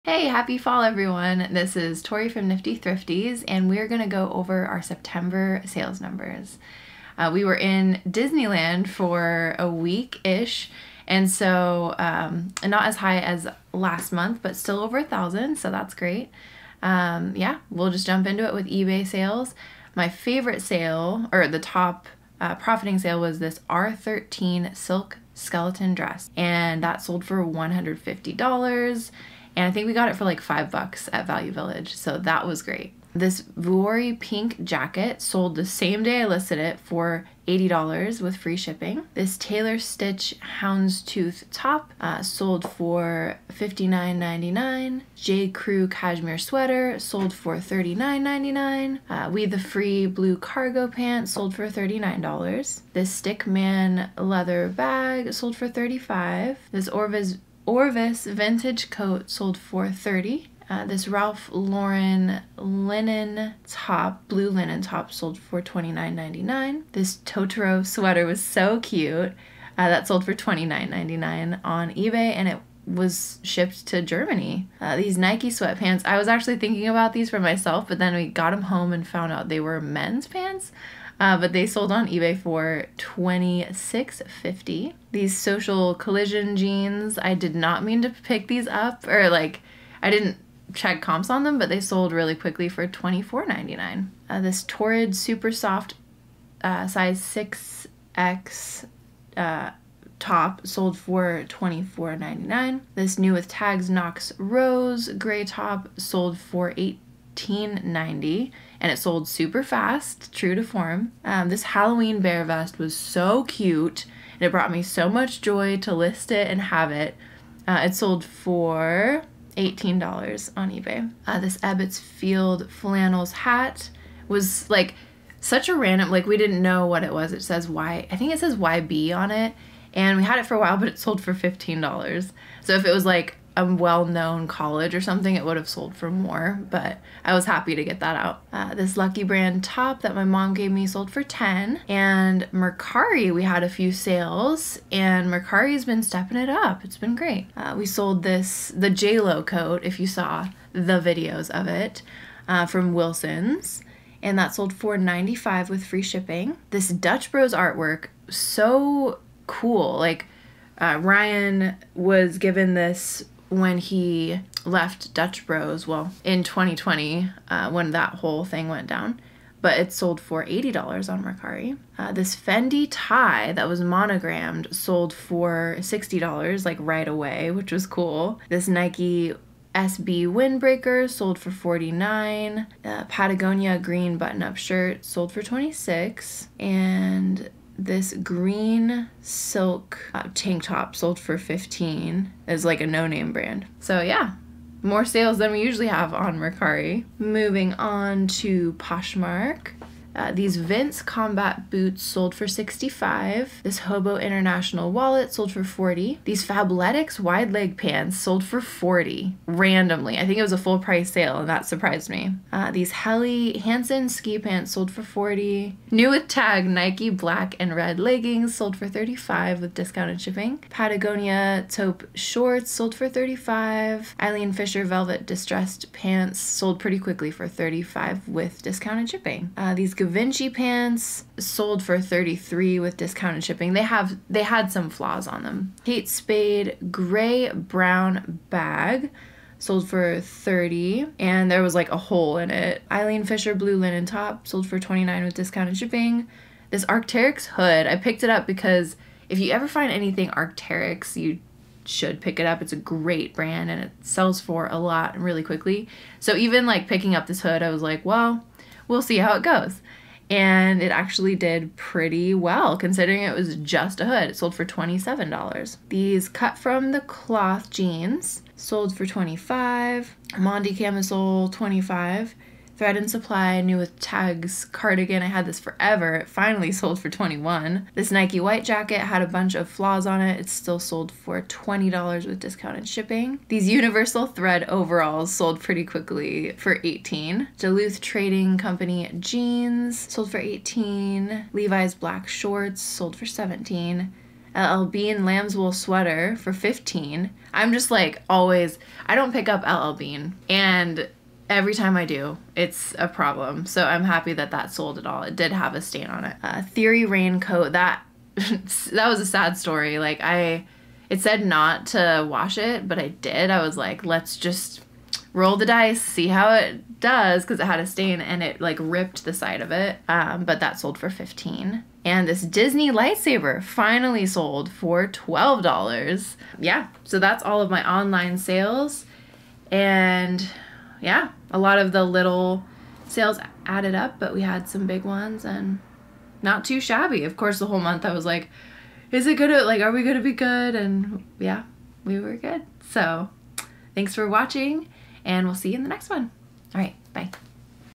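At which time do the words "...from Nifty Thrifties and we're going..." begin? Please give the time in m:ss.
0:02.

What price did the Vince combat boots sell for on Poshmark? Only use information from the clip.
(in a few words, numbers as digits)
$65.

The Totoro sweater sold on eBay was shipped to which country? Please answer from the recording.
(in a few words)
Germany.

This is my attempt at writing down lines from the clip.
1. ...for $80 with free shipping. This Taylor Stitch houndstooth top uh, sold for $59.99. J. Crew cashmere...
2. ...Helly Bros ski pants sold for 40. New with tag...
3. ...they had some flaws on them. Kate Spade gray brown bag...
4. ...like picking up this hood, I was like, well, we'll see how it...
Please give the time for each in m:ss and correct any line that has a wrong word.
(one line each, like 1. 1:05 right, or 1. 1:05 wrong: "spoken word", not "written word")
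1. 0:36 right
2. 3:32 wrong: "Hansen", not "Bros"
3. 3:54 right
4. 4:16 right.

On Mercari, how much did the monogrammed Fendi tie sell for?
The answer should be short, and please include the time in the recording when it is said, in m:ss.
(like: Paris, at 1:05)
$60, at 2:55.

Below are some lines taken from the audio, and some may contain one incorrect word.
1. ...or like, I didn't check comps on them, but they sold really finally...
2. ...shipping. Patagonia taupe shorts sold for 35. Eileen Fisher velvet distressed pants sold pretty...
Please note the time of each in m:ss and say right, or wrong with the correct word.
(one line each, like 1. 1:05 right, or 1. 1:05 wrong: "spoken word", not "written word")
1. 1:29 wrong: "quickly", not "finally"
2. 3:40 right.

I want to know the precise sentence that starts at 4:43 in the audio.
These Universal Thread overalls sold pretty quickly for 18.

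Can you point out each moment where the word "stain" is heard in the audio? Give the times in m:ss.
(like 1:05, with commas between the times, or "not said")
5:05, 5:17.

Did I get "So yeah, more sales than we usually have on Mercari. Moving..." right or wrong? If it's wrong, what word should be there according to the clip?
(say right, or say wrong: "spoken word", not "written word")
right.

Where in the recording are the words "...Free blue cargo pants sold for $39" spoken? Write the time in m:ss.
0:49.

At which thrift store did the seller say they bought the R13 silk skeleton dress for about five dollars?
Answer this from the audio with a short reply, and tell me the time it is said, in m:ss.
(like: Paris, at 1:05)
Value Village, at 0:31.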